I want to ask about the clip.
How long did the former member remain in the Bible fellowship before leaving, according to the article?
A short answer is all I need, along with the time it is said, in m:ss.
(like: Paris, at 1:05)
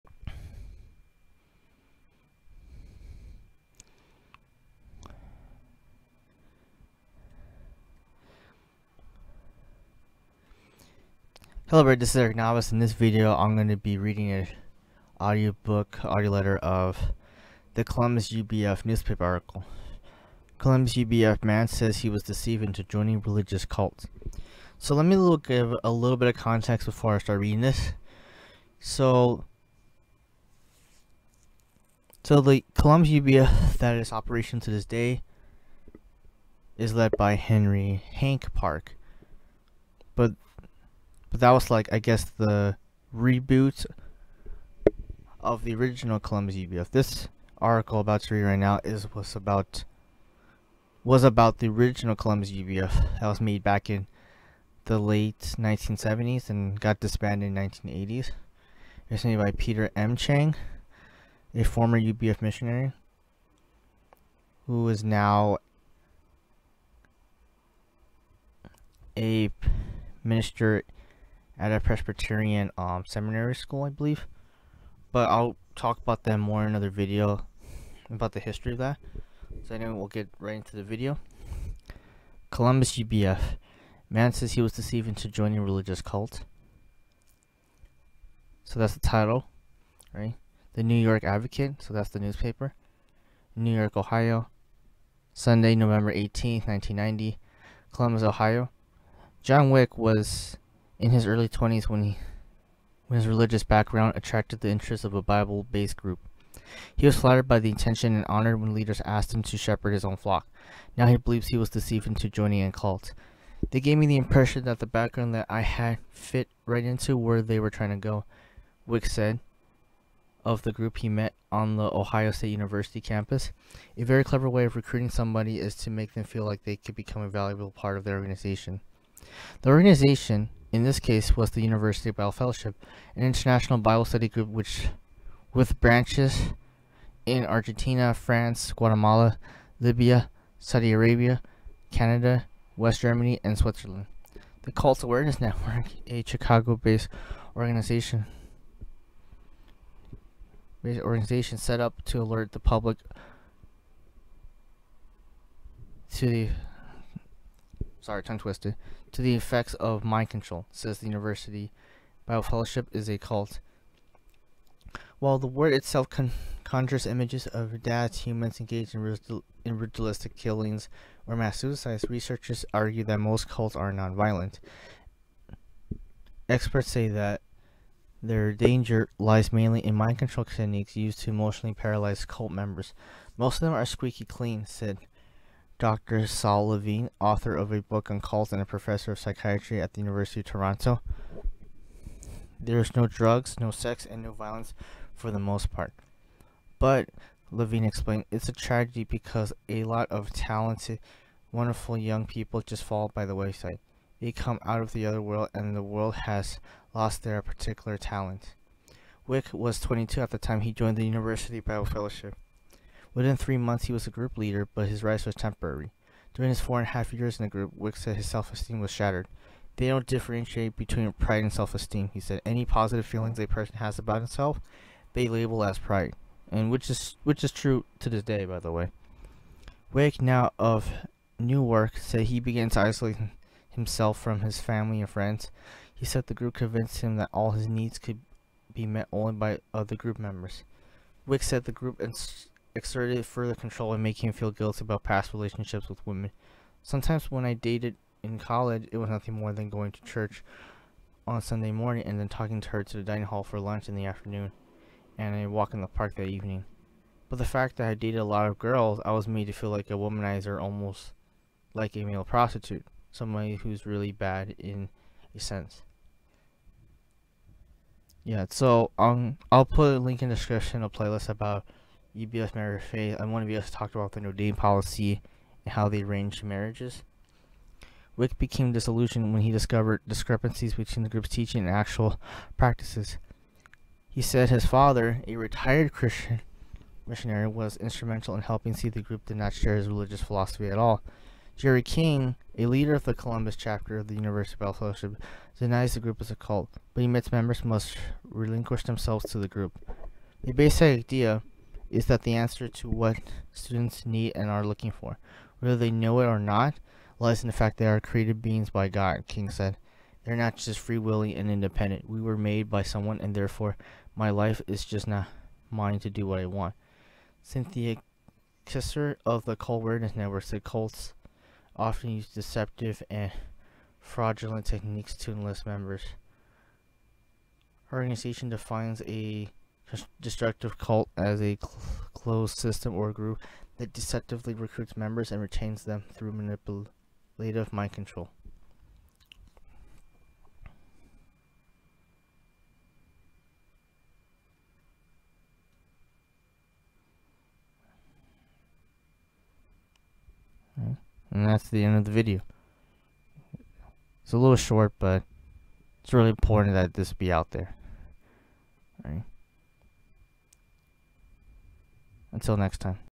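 4.5 years, at 3:36.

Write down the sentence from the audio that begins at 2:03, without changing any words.
A very clever way of recruiting somebody is to make them feel like they could become a valuable part of their organization.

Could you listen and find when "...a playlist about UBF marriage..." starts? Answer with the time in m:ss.
4:30.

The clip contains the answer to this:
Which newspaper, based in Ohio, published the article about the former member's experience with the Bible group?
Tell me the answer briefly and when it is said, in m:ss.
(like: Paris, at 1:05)
The Newark Advocate, at 1:30.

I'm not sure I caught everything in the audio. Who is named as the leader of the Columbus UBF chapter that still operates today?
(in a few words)
Henry Hank Park.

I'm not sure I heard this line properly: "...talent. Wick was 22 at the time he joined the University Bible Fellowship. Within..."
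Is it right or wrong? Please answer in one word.
right.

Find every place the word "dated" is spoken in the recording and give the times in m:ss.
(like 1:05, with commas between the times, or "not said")
4:07, 4:17.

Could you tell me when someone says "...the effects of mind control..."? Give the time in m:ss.
2:39.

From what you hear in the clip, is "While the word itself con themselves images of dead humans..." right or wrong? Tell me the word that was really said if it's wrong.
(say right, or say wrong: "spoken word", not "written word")
wrong: "conjures", not "themselves".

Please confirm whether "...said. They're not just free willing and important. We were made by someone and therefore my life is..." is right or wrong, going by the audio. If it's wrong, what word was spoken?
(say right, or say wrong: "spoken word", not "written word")
wrong: "independent", not "important".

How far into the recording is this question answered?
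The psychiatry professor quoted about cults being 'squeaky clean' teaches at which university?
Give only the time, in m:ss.
3:10.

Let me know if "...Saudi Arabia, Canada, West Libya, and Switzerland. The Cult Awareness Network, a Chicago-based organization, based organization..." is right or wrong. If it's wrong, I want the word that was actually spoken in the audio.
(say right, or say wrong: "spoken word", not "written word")
wrong: "Germany", not "Libya".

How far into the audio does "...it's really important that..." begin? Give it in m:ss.
5:56.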